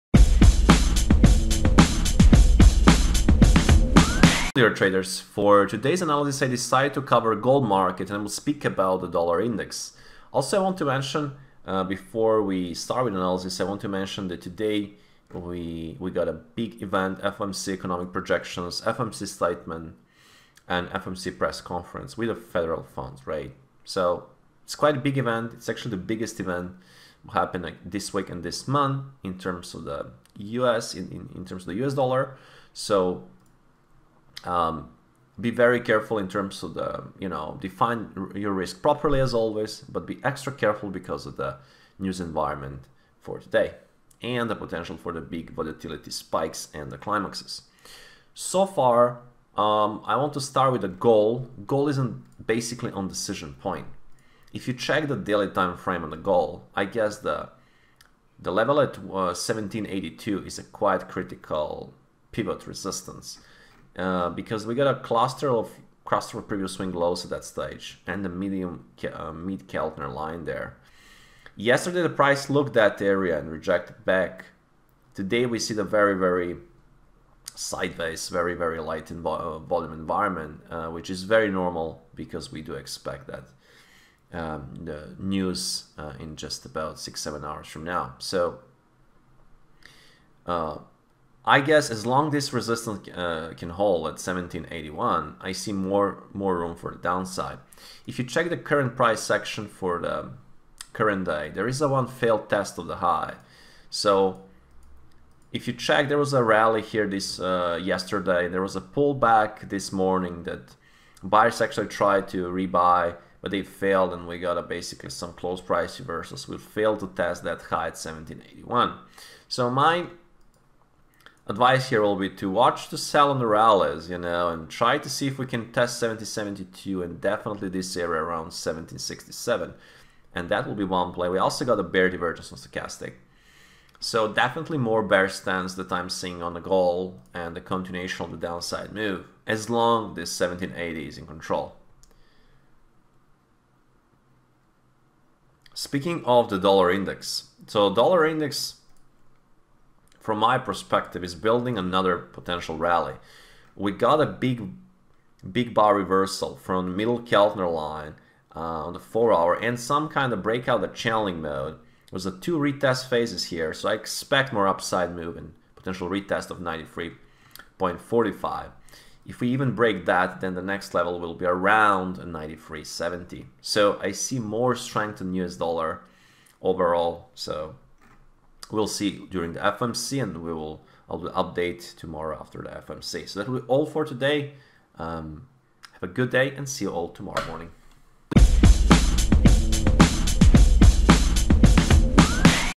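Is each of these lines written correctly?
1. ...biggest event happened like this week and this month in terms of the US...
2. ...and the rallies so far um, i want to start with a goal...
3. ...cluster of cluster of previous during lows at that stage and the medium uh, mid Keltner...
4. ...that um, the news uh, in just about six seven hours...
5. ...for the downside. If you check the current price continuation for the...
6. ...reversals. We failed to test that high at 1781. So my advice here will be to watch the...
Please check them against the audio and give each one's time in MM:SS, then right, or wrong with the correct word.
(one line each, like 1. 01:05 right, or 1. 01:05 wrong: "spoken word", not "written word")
1. 00:26 right
2. 00:46 wrong: "climaxes", not "rallies"
3. 01:04 wrong: "swing", not "during"
4. 01:23 right
5. 01:36 wrong: "section", not "continuation"
6. 01:55 right.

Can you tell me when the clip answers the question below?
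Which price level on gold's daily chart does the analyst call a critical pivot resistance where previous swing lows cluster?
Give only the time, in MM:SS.
00:59.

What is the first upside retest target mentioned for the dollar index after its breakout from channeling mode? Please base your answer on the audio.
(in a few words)
93.45.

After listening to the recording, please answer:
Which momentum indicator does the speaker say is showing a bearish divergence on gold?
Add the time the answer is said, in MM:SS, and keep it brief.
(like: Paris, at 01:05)
Stochastic, at 02:12.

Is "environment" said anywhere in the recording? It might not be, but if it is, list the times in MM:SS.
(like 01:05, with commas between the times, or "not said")
00:42, 01:19.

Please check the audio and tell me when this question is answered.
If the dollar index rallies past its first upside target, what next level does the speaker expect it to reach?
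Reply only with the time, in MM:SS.
02:52.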